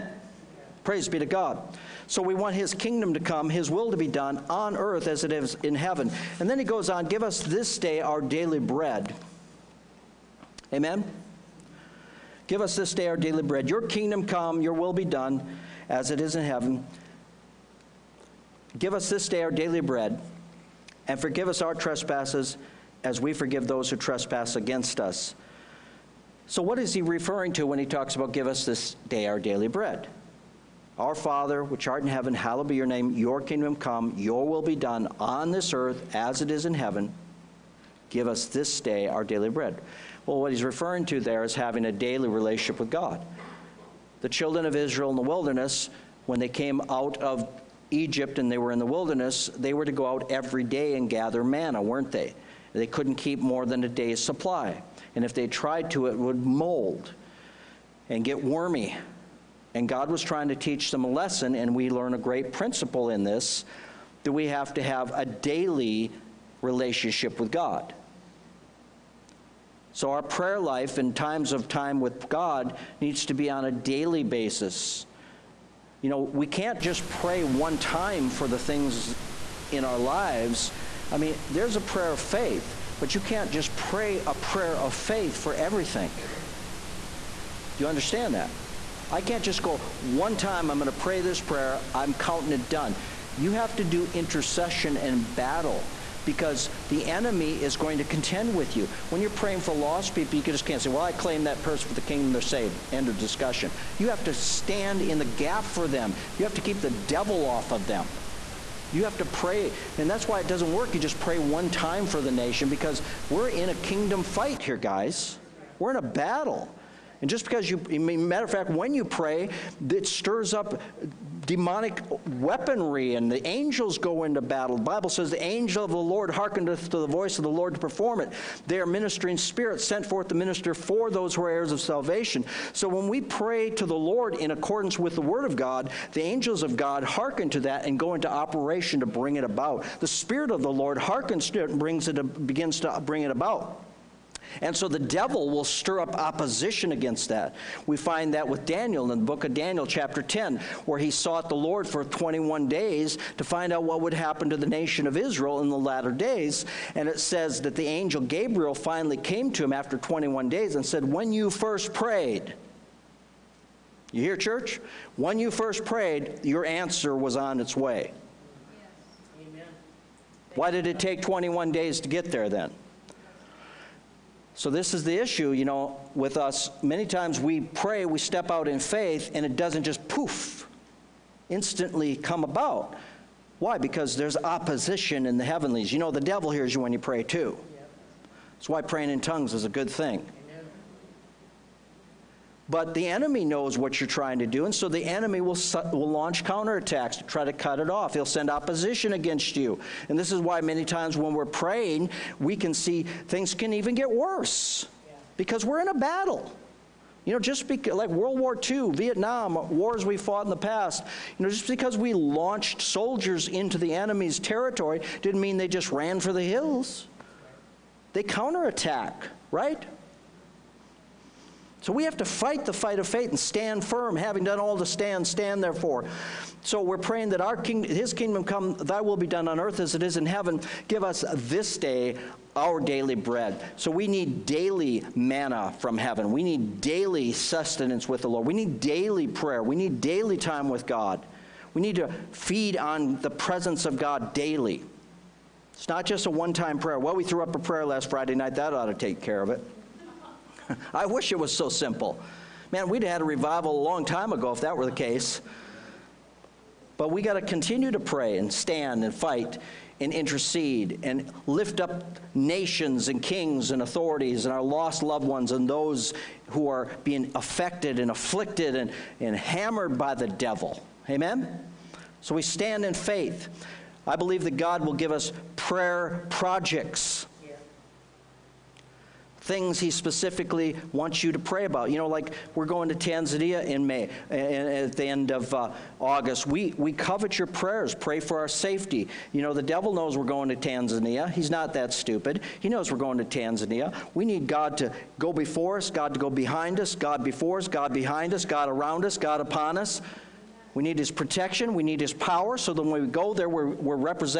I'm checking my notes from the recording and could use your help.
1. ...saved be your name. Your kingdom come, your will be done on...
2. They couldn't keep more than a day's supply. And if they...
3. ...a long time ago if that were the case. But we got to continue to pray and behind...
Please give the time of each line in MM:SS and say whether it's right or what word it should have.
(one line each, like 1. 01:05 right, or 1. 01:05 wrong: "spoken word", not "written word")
1. 00:32 wrong: "hallowed", not "saved"
2. 00:52 right
3. 04:13 wrong: "stand", not "behind".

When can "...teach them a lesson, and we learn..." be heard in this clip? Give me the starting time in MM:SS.
01:00.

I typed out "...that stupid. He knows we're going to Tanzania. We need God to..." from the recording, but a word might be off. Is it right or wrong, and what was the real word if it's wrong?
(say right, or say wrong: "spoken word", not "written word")
right.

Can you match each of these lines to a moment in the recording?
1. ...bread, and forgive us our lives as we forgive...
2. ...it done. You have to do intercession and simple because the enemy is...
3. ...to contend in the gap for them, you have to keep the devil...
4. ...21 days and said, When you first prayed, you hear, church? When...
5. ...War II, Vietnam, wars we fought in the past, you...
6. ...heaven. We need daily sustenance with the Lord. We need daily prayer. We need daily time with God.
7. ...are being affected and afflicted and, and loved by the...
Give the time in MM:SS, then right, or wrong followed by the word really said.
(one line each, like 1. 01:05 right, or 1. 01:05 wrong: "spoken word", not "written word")
1. 00:19 wrong: "trespasses", not "lives"
2. 01:32 wrong: "battle", not "simple"
3. 01:44 wrong: "stand", not "contend"
4. 02:39 right
5. 03:28 right
6. 03:55 right
7. 04:26 wrong: "hammered", not "loved".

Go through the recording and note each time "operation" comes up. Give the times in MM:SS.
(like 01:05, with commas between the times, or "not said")
02:18.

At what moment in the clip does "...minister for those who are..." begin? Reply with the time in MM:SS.
02:10.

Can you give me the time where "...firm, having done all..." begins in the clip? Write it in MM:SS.
03:43.